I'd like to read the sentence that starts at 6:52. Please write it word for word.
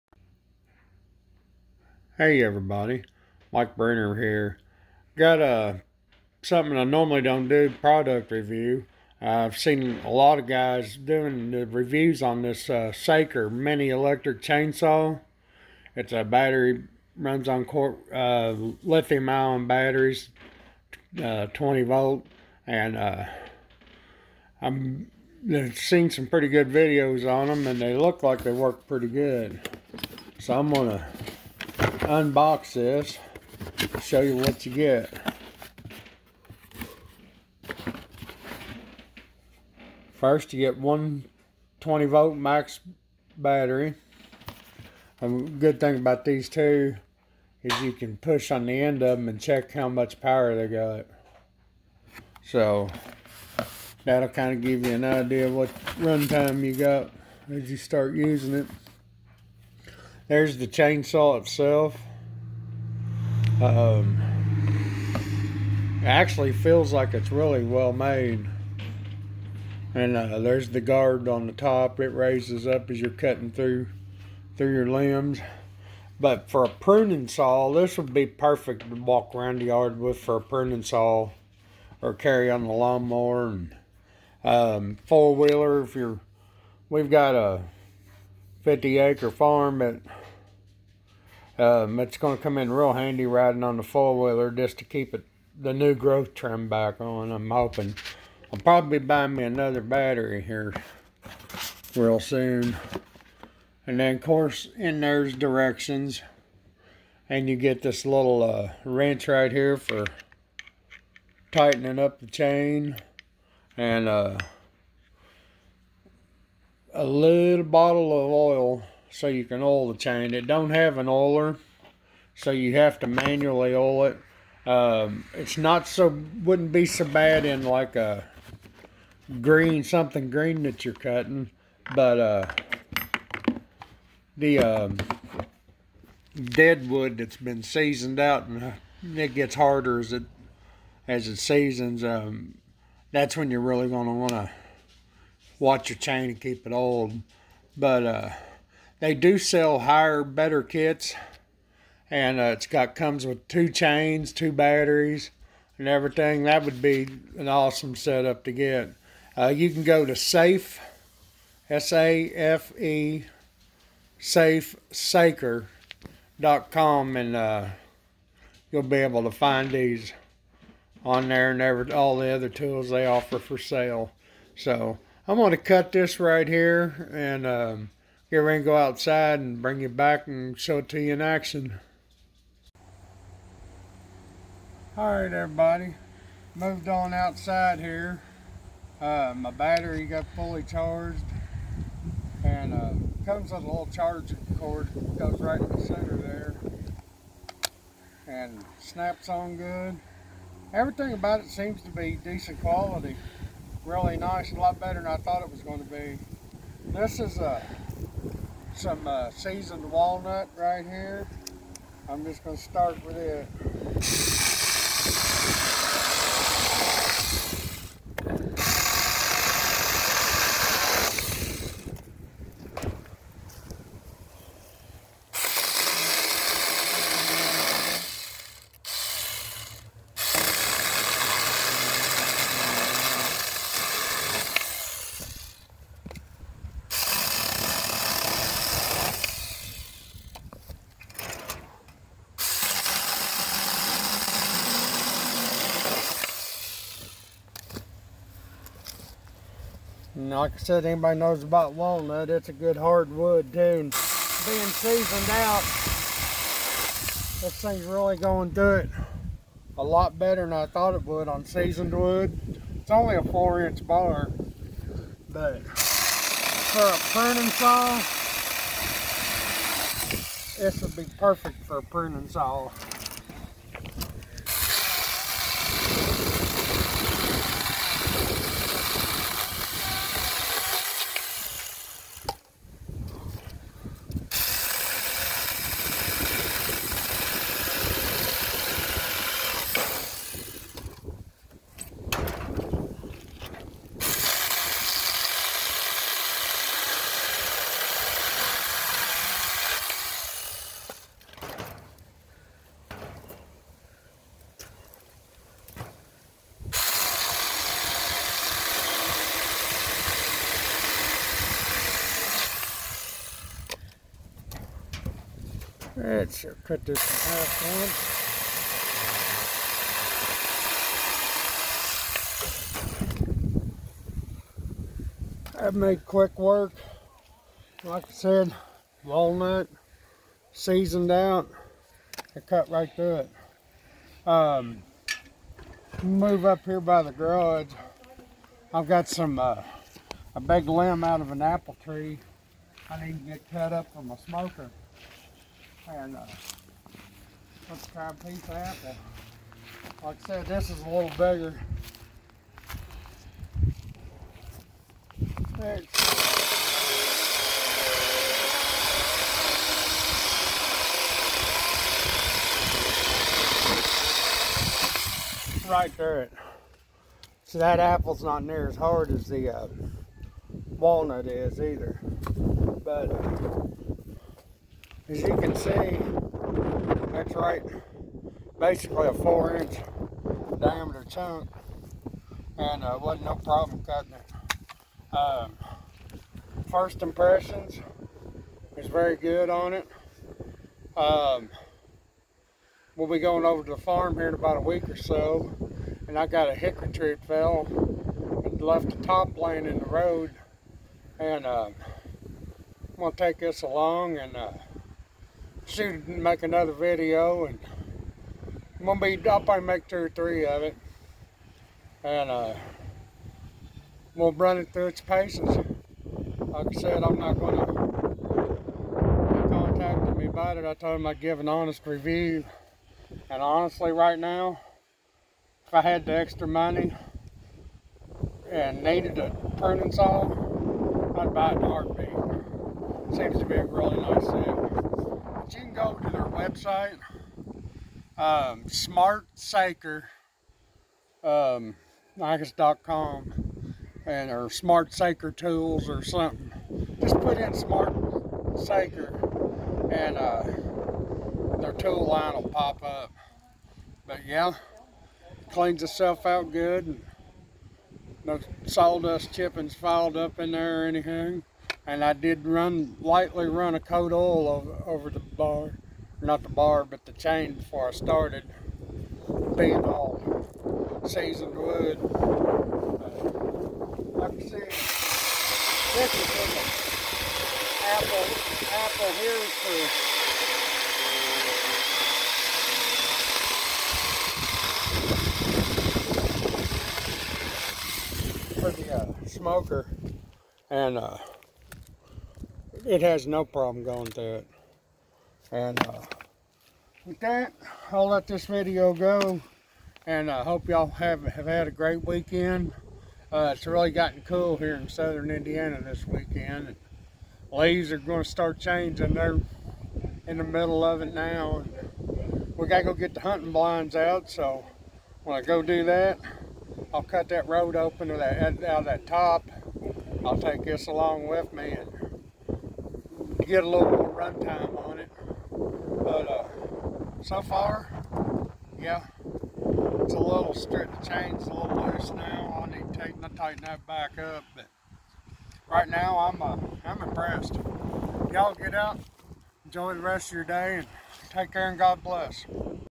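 And uh we'll run it through its paces.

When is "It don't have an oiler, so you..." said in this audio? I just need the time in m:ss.
2:00.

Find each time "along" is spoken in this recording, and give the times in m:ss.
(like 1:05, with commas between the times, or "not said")
6:43, 8:40.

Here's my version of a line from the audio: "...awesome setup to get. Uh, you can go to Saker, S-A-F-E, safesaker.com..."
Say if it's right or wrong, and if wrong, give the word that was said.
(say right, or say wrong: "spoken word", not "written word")
wrong: "Safe", not "Saker".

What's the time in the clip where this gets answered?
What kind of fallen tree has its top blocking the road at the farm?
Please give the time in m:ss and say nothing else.
6:36.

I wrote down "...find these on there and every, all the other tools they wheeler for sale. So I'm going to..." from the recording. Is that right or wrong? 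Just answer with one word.
wrong.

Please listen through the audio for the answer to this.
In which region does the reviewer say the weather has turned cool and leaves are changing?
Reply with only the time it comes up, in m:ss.
8:24.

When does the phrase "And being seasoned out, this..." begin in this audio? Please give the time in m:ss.
4:13.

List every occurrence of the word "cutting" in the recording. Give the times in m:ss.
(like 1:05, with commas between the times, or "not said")
1:13, 2:10, 6:23.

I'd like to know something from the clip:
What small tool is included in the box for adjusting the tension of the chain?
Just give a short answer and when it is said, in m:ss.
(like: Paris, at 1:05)
wrench, at 1:48.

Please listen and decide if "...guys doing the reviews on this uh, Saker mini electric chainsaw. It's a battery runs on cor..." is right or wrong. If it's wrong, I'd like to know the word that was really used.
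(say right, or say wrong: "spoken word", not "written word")
right.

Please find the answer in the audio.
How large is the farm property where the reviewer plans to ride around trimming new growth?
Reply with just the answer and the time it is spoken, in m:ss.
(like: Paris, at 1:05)
50 acre, at 1:28.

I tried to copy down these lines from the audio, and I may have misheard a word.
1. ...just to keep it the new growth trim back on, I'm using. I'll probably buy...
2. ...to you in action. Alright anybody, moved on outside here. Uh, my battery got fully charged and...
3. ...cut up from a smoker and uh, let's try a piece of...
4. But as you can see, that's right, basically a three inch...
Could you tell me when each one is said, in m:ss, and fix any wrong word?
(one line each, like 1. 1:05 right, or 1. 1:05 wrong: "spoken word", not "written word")
1. 1:34 wrong: "hoping", not "using"
2. 3:00 wrong: "everybody", not "anybody"
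3. 5:43 right
4. 6:12 wrong: "four", not "three".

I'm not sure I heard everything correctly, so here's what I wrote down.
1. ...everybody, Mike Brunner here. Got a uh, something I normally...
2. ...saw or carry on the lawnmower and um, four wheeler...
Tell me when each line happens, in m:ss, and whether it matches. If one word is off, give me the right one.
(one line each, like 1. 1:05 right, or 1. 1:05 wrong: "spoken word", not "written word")
1. 0:02 right
2. 1:20 right.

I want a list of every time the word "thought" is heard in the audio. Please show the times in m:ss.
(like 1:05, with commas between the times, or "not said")
3:25, 4:20.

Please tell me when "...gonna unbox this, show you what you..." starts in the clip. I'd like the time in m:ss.
0:30.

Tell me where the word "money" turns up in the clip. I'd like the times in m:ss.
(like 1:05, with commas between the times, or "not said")
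7:06.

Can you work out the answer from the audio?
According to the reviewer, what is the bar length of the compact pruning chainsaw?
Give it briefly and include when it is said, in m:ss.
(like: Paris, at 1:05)
4 inch, at 4:23.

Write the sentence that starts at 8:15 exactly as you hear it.
And uh, with that, I'll let this video go.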